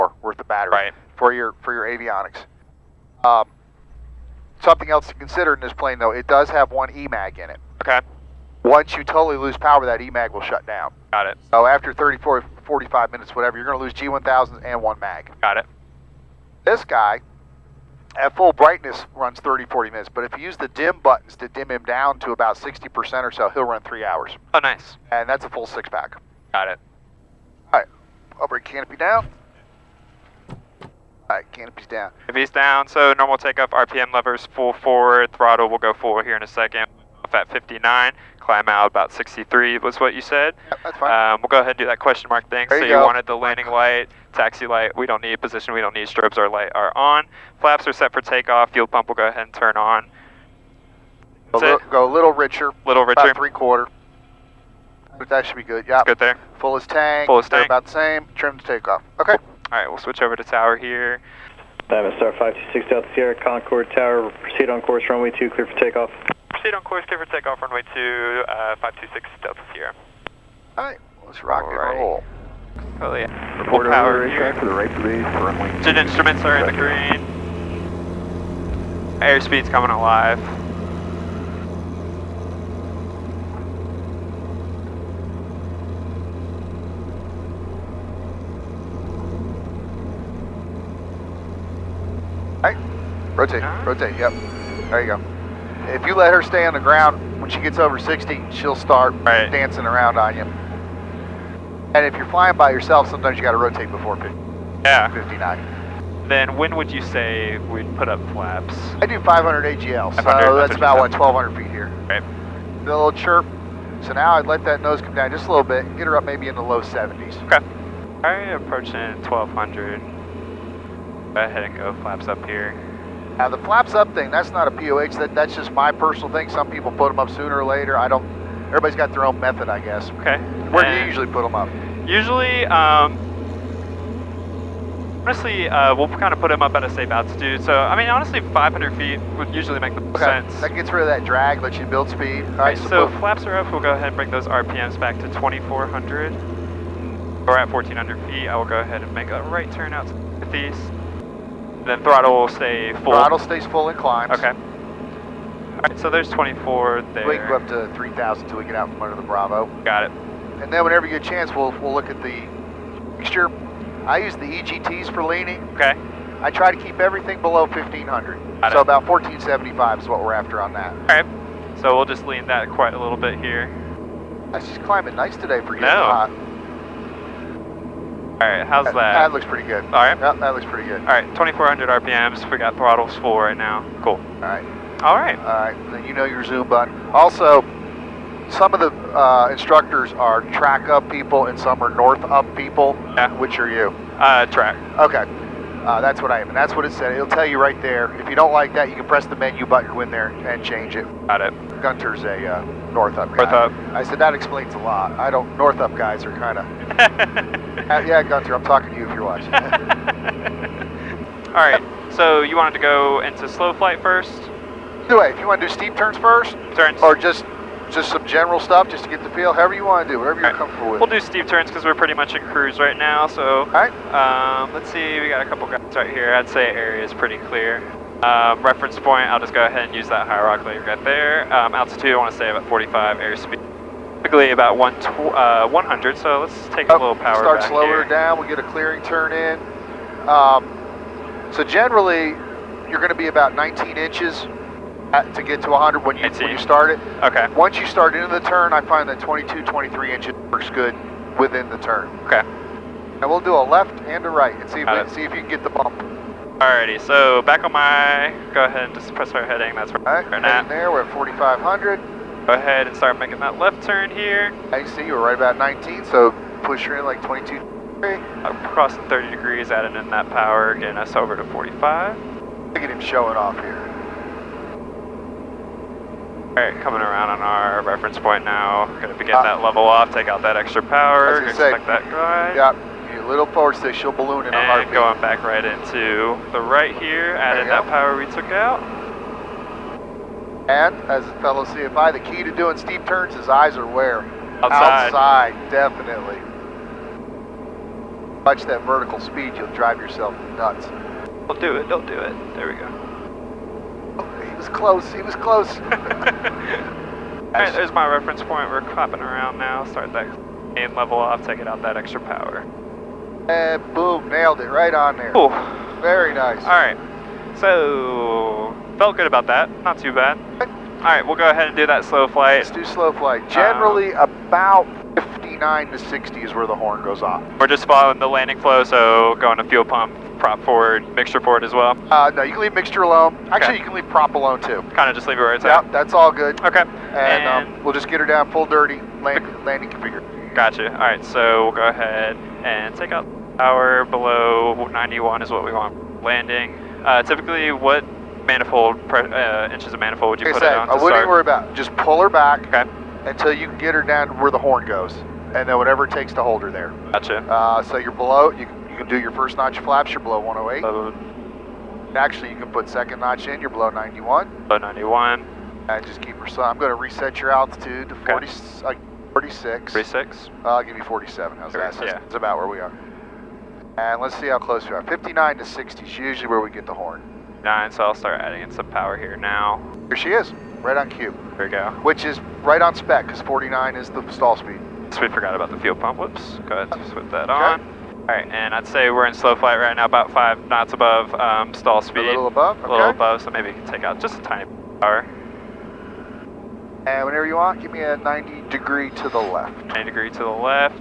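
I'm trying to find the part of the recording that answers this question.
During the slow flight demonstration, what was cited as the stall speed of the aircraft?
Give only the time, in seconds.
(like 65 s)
383 s.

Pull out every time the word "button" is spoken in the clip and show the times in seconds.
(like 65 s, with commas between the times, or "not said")
20 s, 186 s, 199 s.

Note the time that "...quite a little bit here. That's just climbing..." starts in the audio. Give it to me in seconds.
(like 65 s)
172 s.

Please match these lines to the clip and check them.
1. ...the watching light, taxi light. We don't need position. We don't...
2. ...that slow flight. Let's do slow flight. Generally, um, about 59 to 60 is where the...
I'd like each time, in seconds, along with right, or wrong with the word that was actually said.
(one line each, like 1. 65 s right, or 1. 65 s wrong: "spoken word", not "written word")
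1. 43 s wrong: "landing", not "watching"
2. 321 s right.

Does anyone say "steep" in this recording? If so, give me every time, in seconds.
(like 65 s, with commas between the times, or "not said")
215 s, 221 s, 292 s.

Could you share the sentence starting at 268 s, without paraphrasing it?
I'm crossing 30 degrees, adding in that power, getting us over to 45.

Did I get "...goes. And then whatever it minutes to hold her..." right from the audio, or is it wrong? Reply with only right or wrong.
wrong.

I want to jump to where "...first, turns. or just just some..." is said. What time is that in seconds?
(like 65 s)
216 s.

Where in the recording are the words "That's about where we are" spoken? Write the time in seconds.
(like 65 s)
372 s.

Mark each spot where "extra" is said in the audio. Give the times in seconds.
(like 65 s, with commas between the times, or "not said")
280 s, 311 s.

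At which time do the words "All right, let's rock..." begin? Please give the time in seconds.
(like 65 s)
70 s.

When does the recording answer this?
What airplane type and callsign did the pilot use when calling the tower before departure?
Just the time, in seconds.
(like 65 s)
61 s.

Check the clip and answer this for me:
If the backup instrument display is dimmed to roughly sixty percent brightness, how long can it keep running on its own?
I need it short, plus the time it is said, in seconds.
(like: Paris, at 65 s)
3 hours, at 23 s.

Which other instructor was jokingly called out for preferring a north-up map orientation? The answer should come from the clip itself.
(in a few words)
Gunther.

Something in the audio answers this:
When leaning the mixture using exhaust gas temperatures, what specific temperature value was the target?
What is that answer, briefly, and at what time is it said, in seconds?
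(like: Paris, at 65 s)
1475, at 169 s.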